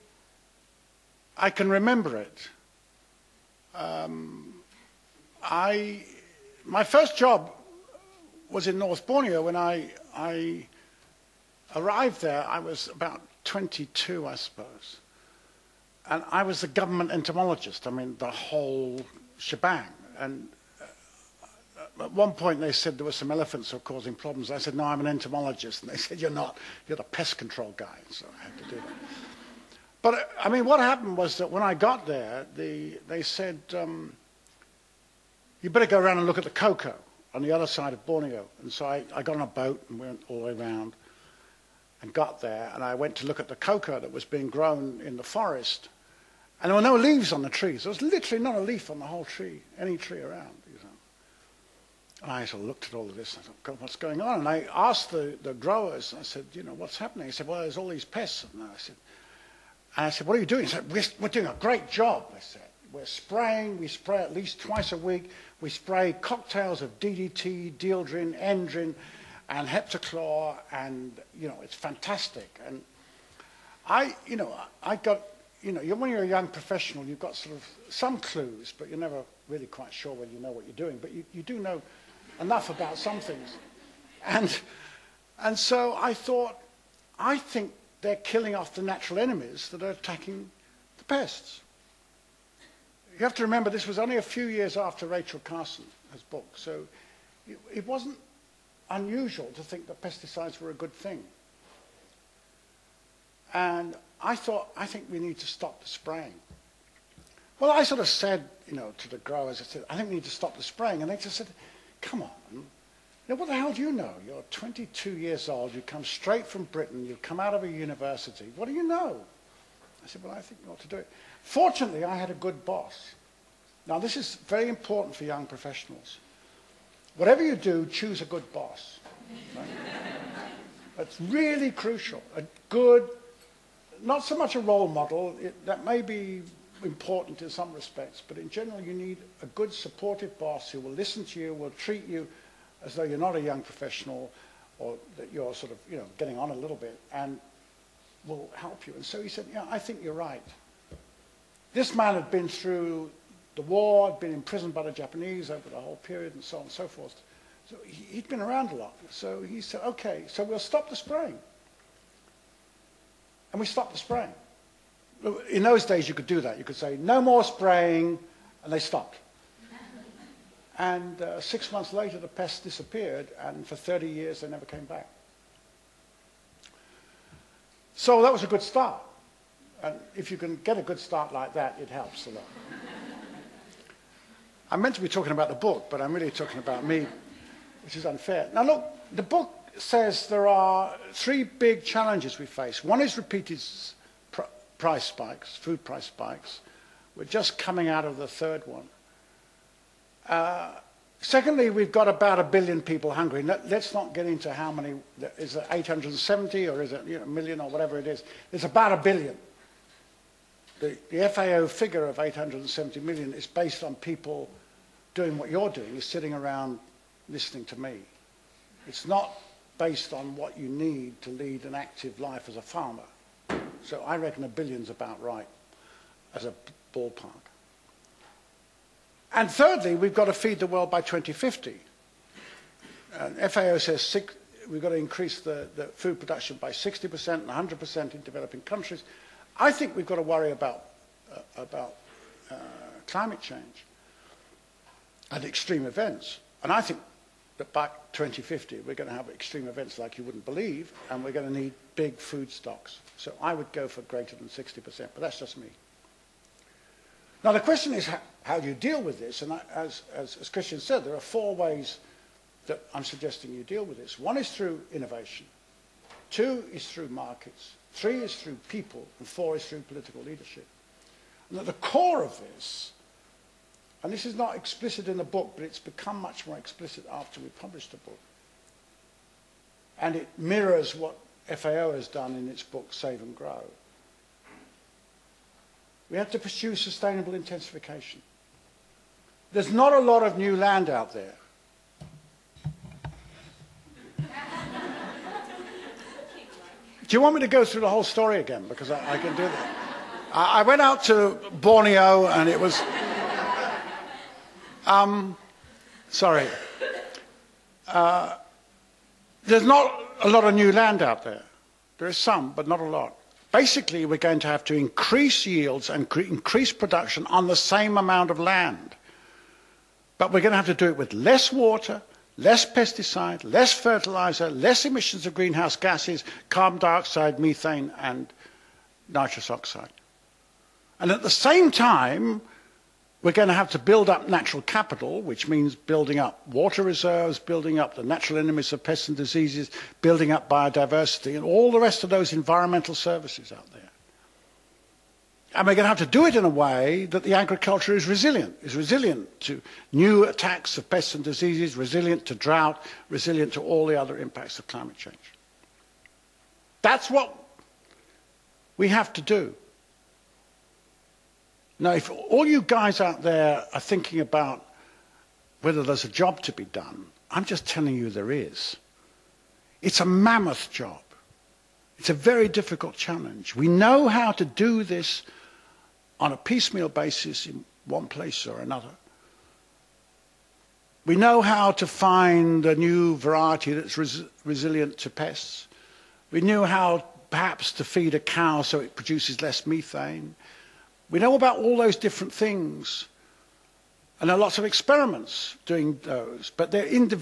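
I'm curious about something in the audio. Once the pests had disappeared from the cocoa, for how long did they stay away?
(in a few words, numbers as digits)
30 years.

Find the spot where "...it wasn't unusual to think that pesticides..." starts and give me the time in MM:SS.
01:37.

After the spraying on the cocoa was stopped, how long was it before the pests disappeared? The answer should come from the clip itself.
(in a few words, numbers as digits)
6 months.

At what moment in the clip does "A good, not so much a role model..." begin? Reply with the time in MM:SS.
02:12.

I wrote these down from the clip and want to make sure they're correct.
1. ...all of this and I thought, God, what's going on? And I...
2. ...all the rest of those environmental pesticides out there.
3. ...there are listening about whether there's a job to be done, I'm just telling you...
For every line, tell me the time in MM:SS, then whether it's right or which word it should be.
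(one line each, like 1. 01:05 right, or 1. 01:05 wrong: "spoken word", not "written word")
1. 00:52 right
2. 05:41 wrong: "services", not "pesticides"
3. 06:03 wrong: "thinking", not "listening".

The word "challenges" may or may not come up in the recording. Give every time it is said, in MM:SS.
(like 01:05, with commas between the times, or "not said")
03:11, 06:12.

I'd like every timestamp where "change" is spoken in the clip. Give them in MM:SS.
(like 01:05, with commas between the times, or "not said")
04:03, 05:54.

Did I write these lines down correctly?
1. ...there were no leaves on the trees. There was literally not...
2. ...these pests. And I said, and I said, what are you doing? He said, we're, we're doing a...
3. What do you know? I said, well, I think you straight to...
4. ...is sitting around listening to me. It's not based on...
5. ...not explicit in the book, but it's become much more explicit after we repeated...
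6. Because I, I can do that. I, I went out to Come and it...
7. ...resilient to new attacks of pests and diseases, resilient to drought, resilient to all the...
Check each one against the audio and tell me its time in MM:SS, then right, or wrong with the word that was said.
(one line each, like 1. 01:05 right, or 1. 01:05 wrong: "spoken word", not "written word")
1. 00:46 right
2. 00:57 right
3. 01:58 wrong: "ought", not "straight"
4. 03:35 right
5. 04:34 wrong: "published", not "repeated"
6. 04:58 wrong: "Borneo", not "Come"
7. 05:48 right.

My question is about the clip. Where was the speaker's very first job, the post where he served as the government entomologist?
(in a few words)
North Borneo.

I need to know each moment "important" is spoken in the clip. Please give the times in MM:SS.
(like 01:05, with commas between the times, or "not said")
02:04, 02:16.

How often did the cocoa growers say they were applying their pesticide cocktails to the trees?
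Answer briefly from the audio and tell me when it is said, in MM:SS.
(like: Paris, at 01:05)
twice a week, at 01:04.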